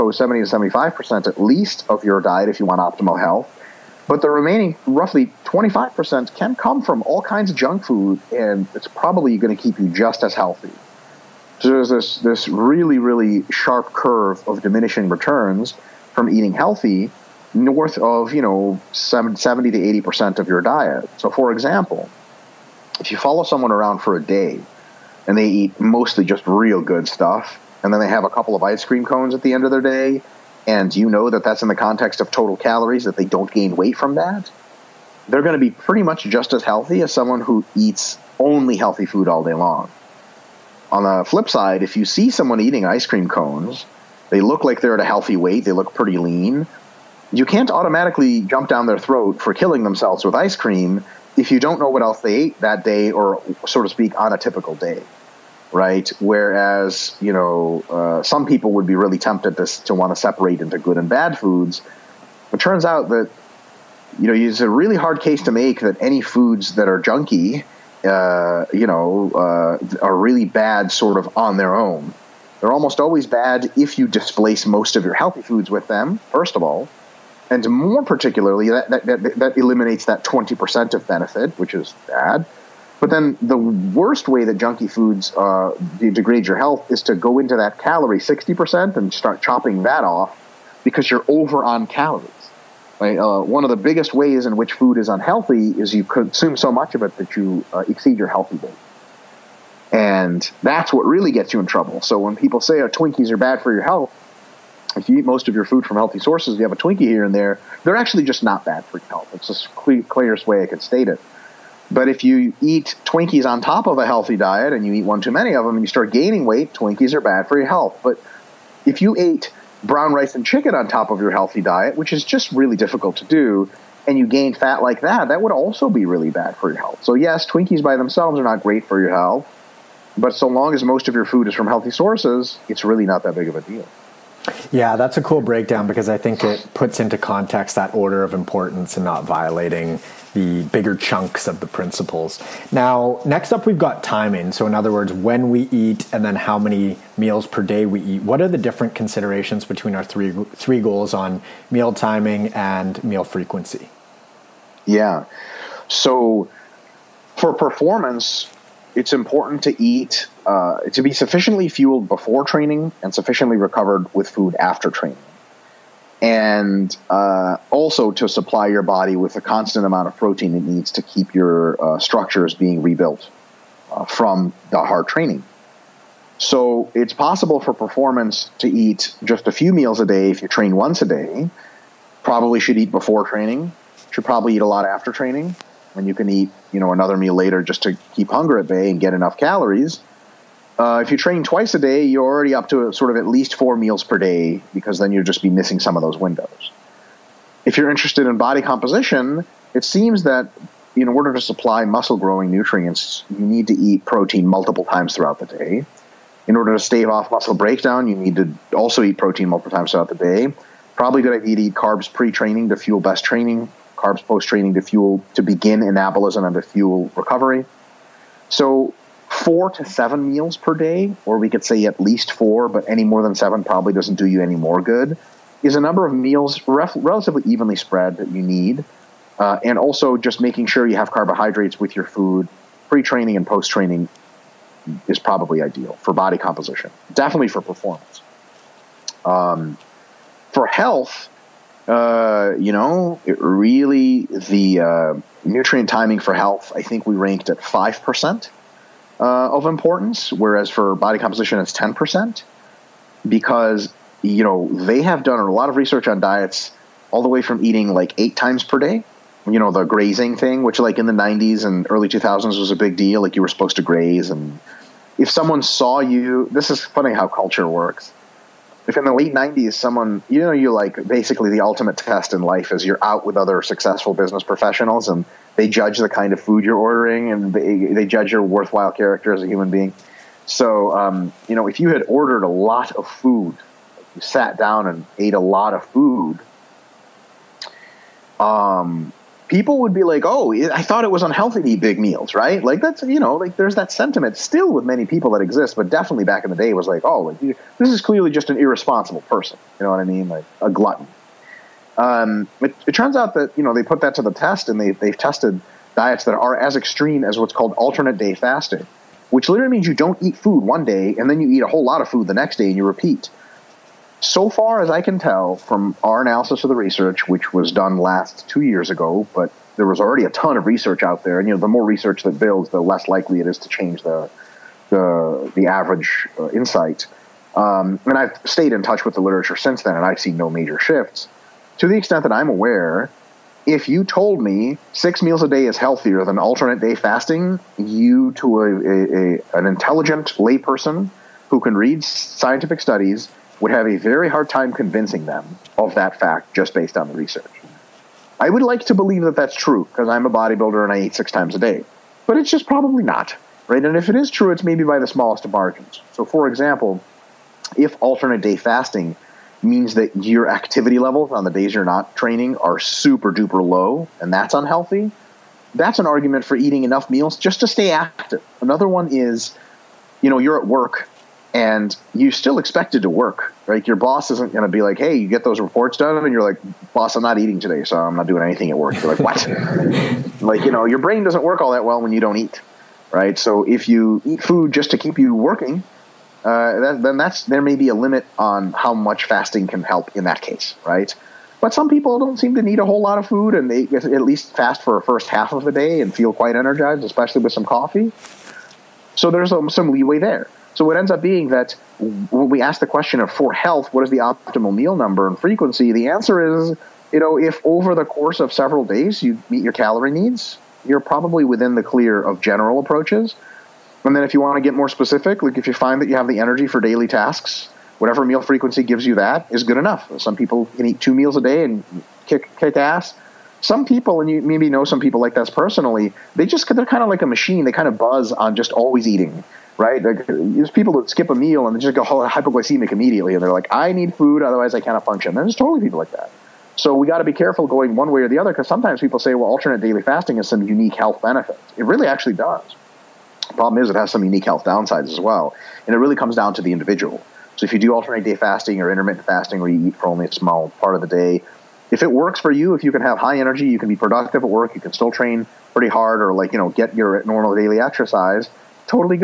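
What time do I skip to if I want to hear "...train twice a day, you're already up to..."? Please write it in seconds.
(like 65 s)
191 s.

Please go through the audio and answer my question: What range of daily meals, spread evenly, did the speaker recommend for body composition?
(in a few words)
4 to 7.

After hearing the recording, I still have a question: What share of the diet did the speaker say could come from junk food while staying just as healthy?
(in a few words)
25%.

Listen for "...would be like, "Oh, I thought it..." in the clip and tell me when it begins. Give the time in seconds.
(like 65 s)
289 s.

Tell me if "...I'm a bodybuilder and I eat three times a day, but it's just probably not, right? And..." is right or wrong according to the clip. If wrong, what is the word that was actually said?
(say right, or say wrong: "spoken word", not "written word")
wrong: "six", not "three".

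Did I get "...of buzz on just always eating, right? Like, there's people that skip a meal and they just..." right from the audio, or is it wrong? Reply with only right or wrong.
right.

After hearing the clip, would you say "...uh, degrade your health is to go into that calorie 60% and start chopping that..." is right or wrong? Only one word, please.
right.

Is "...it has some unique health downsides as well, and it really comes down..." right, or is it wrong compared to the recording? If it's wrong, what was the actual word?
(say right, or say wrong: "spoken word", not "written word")
right.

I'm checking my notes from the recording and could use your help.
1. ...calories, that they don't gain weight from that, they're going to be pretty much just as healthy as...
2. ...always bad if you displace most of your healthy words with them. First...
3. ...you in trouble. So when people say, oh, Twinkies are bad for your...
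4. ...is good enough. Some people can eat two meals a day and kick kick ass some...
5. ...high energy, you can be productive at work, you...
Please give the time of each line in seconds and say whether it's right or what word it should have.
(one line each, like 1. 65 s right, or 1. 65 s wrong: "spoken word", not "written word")
1. 32 s right
2. 73 s wrong: "foods", not "words"
3. 101 s right
4. 419 s right
5. 453 s right.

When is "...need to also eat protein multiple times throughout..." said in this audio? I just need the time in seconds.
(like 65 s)
208 s.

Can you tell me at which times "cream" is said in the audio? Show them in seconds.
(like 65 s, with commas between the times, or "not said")
28 s, 43 s, 50 s.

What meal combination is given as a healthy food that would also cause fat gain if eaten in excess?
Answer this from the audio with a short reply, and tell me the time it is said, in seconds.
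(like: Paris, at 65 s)
Brown rice and chicken, at 119 s.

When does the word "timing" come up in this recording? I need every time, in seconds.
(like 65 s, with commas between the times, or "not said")
144 s, 151 s, 245 s.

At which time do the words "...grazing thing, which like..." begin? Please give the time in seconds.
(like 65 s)
259 s.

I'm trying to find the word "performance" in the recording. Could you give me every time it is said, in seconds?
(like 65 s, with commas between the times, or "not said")
157 s, 177 s, 237 s.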